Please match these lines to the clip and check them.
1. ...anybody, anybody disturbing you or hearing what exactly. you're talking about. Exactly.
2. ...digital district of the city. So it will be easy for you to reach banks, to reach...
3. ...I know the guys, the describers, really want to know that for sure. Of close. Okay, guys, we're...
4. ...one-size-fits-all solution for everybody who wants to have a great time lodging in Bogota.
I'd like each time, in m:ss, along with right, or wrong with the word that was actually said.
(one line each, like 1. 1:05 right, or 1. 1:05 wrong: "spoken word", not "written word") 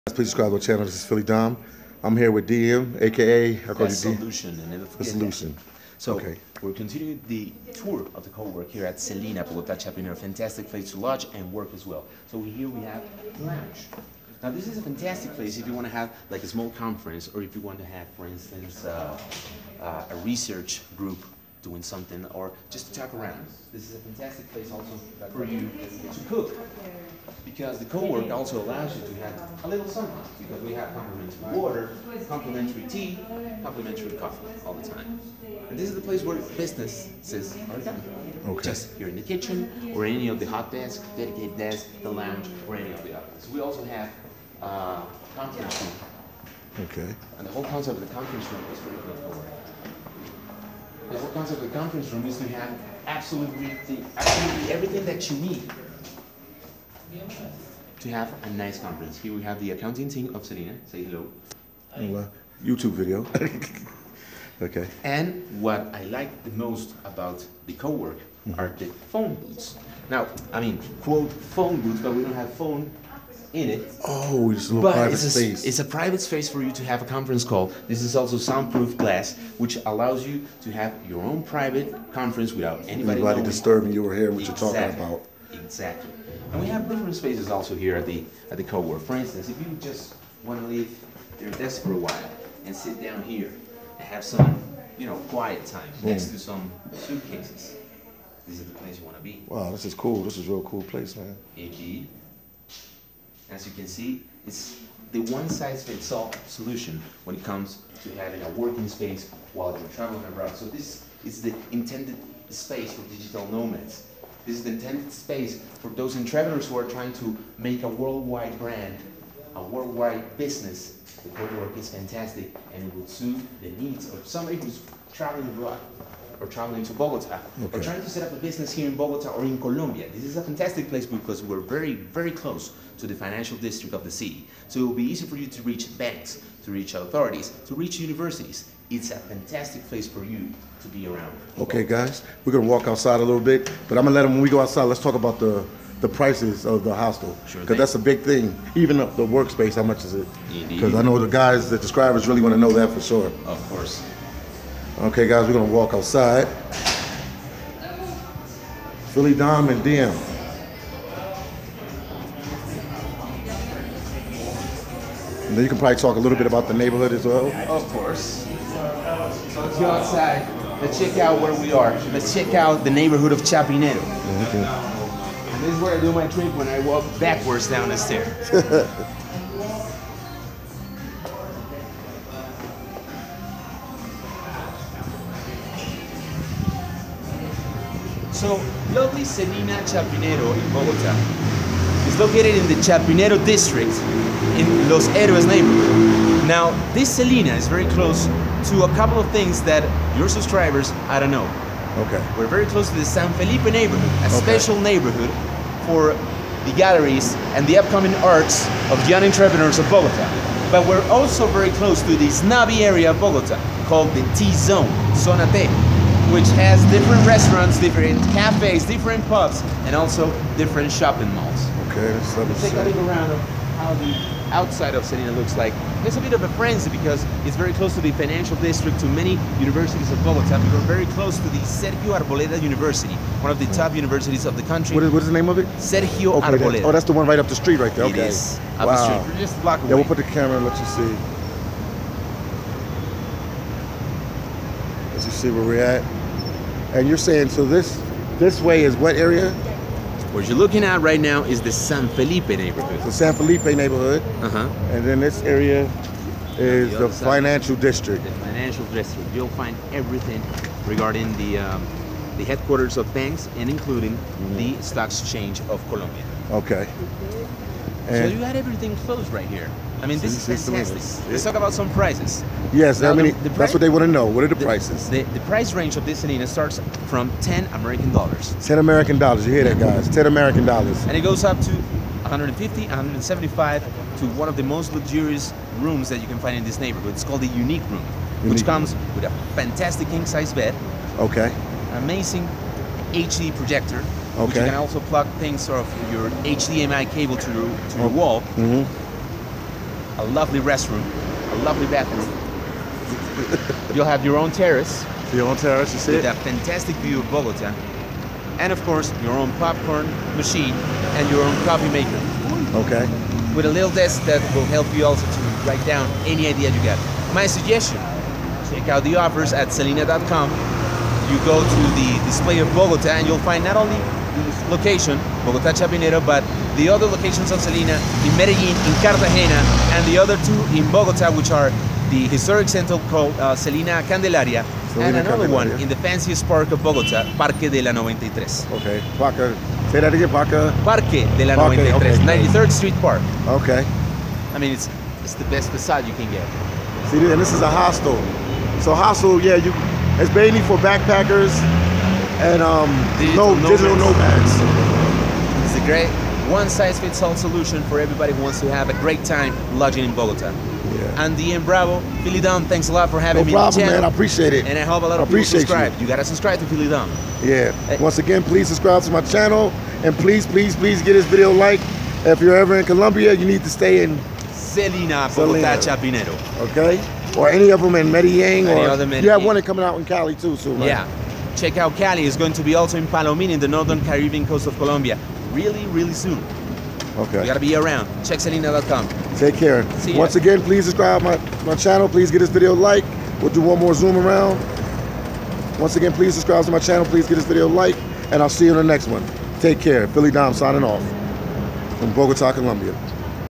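1. 1:22 right
2. 2:13 wrong: "financial", not "digital"
3. 2:30 wrong: "course", not "close"
4. 5:56 right.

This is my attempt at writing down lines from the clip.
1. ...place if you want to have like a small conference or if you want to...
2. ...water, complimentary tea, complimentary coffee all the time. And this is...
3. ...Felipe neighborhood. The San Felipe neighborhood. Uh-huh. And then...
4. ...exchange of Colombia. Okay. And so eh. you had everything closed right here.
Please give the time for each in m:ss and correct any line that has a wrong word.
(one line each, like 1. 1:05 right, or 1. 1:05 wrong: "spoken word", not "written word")
1. 0:15 right
2. 0:31 right
3. 4:12 right
4. 4:25 right.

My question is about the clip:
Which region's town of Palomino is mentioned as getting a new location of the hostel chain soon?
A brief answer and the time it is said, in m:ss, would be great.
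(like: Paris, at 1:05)
Northern Caribbean coast, at 6:23.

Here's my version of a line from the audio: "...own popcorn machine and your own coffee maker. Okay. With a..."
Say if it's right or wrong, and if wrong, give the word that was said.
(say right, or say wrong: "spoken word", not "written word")
right.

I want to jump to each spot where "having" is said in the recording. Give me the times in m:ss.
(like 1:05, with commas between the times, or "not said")
1:48, 6:03.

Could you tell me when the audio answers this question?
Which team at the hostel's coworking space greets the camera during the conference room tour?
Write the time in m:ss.
0:59.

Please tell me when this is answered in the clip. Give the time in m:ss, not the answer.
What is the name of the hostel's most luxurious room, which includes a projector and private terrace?
4:47.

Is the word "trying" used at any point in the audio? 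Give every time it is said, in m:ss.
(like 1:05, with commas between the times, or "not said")
1:56, 2:07.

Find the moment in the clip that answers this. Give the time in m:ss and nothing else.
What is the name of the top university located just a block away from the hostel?
3:51.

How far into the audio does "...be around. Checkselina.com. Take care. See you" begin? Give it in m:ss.
6:27.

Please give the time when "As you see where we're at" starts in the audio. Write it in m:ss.
4:05.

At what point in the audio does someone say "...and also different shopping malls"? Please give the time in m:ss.
3:39.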